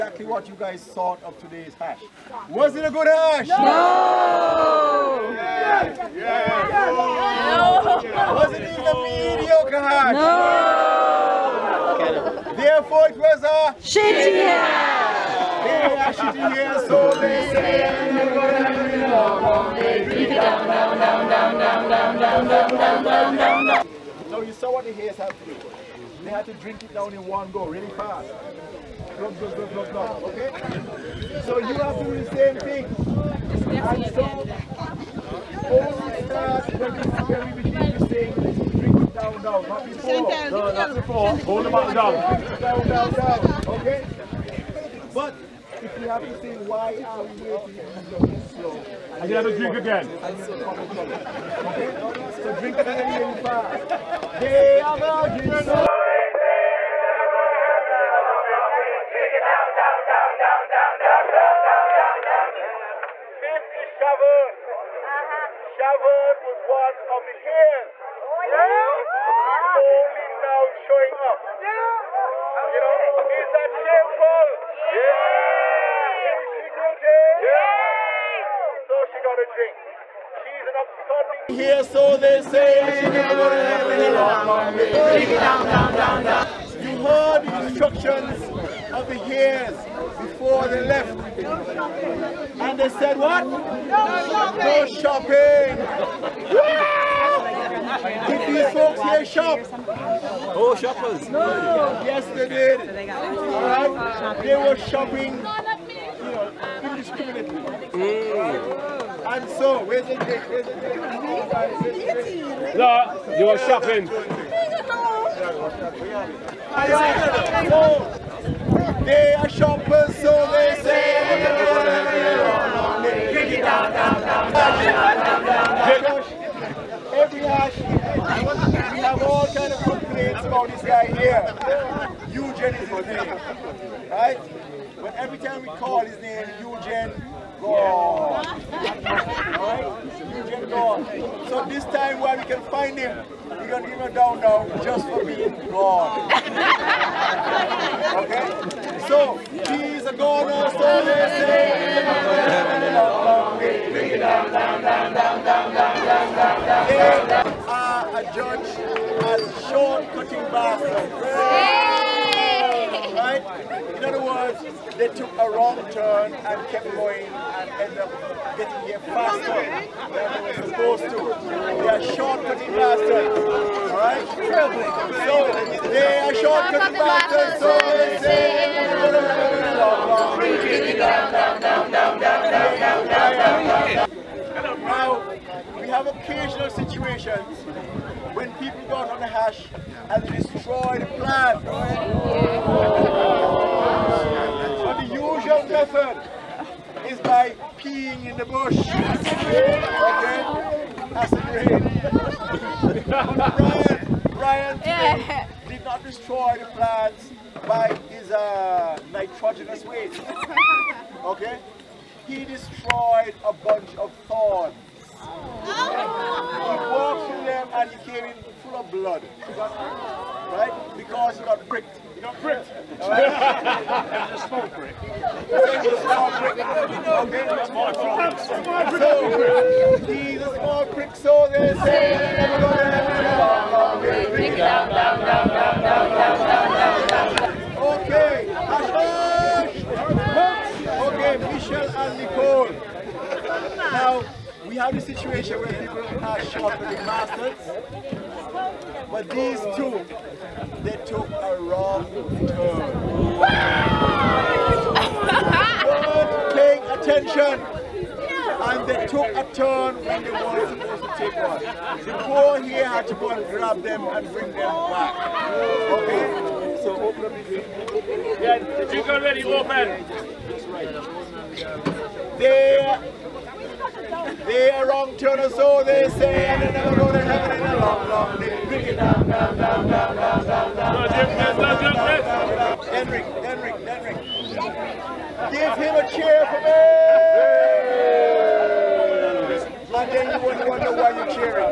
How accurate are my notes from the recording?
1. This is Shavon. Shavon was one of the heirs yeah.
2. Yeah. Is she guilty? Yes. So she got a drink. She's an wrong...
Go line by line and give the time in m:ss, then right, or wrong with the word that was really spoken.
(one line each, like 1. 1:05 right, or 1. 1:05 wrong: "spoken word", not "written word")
1. 1:03 right
2. 1:14 wrong: "absconding", not "wrong".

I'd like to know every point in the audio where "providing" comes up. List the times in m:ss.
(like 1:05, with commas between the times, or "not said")
not said.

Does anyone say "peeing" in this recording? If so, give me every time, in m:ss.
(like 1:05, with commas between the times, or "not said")
3:17.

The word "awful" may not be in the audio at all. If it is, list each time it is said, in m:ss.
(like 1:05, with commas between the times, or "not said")
not said.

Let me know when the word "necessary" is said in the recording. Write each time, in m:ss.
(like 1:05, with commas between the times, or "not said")
not said.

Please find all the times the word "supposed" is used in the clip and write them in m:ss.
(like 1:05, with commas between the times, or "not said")
2:50, 4:20.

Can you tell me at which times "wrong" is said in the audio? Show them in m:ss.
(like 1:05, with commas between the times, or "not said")
2:45, 4:11, 4:34.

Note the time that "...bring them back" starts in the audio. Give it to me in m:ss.
4:24.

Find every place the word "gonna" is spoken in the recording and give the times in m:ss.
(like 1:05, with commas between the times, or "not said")
2:23.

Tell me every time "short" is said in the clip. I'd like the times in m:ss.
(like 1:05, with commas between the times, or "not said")
2:39, 2:52, 2:56.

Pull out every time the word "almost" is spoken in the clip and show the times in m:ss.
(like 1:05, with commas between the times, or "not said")
not said.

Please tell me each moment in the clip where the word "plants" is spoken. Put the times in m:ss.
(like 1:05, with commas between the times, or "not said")
3:11, 3:26.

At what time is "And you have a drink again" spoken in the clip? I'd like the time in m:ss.
0:49.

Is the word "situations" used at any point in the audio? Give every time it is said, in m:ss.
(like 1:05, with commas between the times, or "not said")
3:06, 4:04.